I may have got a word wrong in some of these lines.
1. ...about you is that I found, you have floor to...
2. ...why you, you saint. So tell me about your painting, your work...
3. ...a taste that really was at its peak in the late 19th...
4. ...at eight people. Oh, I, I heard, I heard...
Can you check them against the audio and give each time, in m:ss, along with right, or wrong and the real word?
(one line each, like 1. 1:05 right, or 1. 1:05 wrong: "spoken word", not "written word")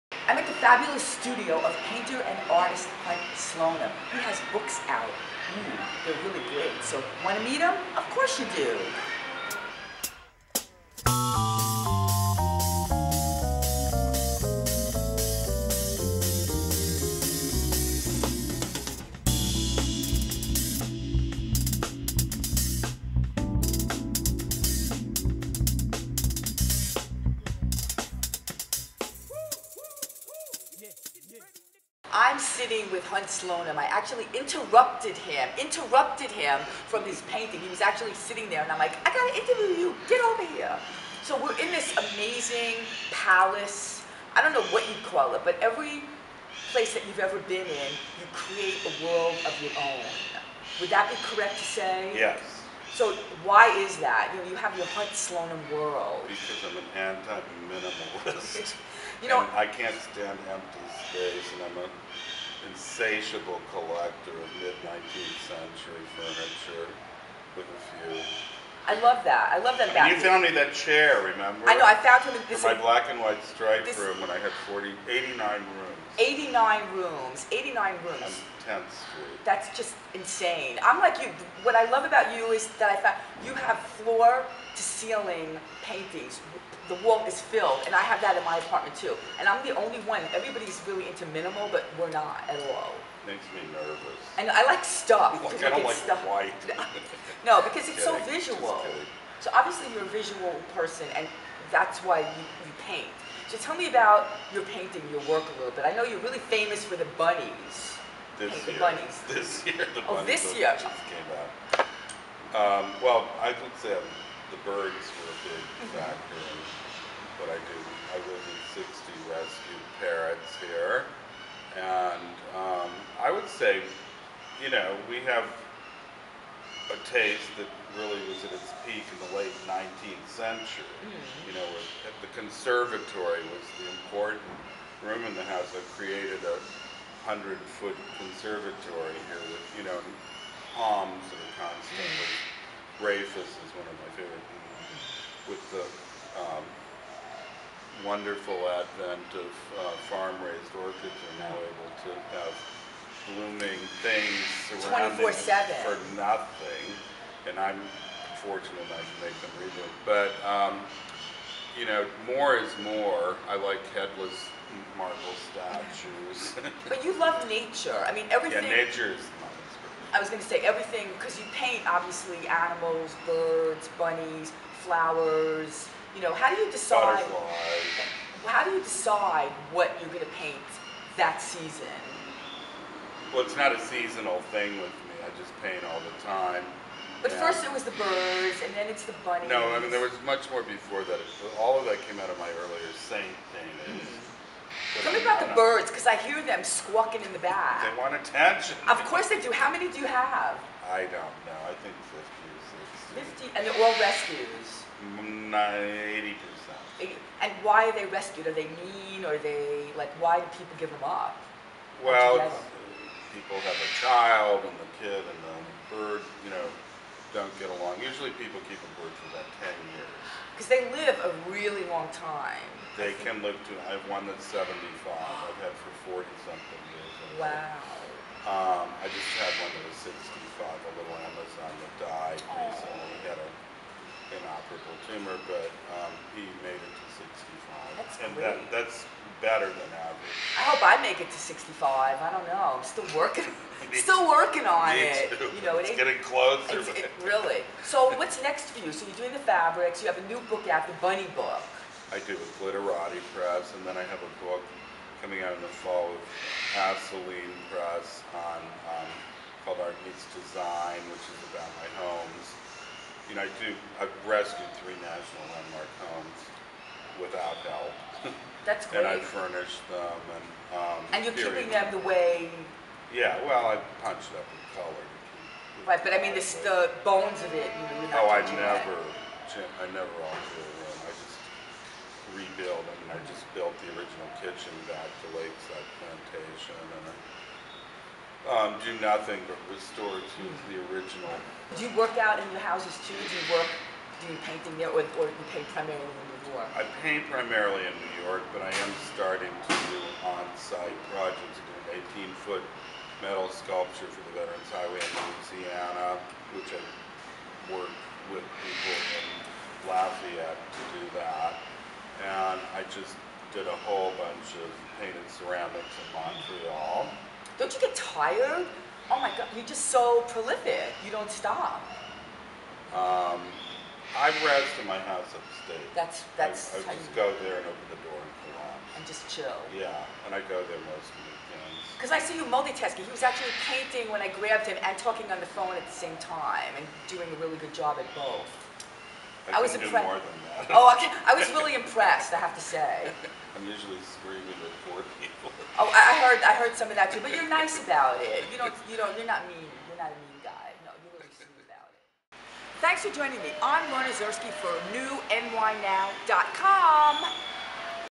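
1. 1:22 right
2. 1:42 wrong: "paint", not "saint"
3. 2:06 right
4. 5:44 wrong: "four", not "eight".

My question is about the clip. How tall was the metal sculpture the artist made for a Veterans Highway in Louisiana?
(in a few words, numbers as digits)
18 feet.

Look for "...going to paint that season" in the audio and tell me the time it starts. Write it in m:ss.
3:00.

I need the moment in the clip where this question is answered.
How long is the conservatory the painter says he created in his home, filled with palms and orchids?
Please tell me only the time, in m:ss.
2:16.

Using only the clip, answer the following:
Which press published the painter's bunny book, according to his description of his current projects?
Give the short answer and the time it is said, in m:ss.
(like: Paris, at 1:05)
Glitterati Press, at 4:12.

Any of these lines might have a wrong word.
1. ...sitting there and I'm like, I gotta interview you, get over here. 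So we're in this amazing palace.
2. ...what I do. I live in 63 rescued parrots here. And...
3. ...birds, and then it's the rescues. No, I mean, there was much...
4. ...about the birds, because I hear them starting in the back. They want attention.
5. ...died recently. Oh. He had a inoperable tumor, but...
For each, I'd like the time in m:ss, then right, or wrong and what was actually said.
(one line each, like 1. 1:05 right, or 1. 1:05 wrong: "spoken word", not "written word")
1. 0:38 right
2. 1:57 wrong: "60", not "63"
3. 3:07 wrong: "bunnies", not "rescues"
4. 3:15 wrong: "squawking", not "starting"
5. 3:52 right.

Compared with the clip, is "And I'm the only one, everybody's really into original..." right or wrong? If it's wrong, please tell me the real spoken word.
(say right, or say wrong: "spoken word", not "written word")
wrong: "minimal", not "original".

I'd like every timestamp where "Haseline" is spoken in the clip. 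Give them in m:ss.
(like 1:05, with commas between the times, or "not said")
4:16.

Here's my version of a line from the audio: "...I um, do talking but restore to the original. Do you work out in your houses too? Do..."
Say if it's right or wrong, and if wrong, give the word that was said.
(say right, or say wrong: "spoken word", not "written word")
wrong: "nothing", not "talking".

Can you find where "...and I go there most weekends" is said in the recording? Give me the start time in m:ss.
5:30.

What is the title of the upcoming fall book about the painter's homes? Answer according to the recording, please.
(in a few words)
Art Meets Design.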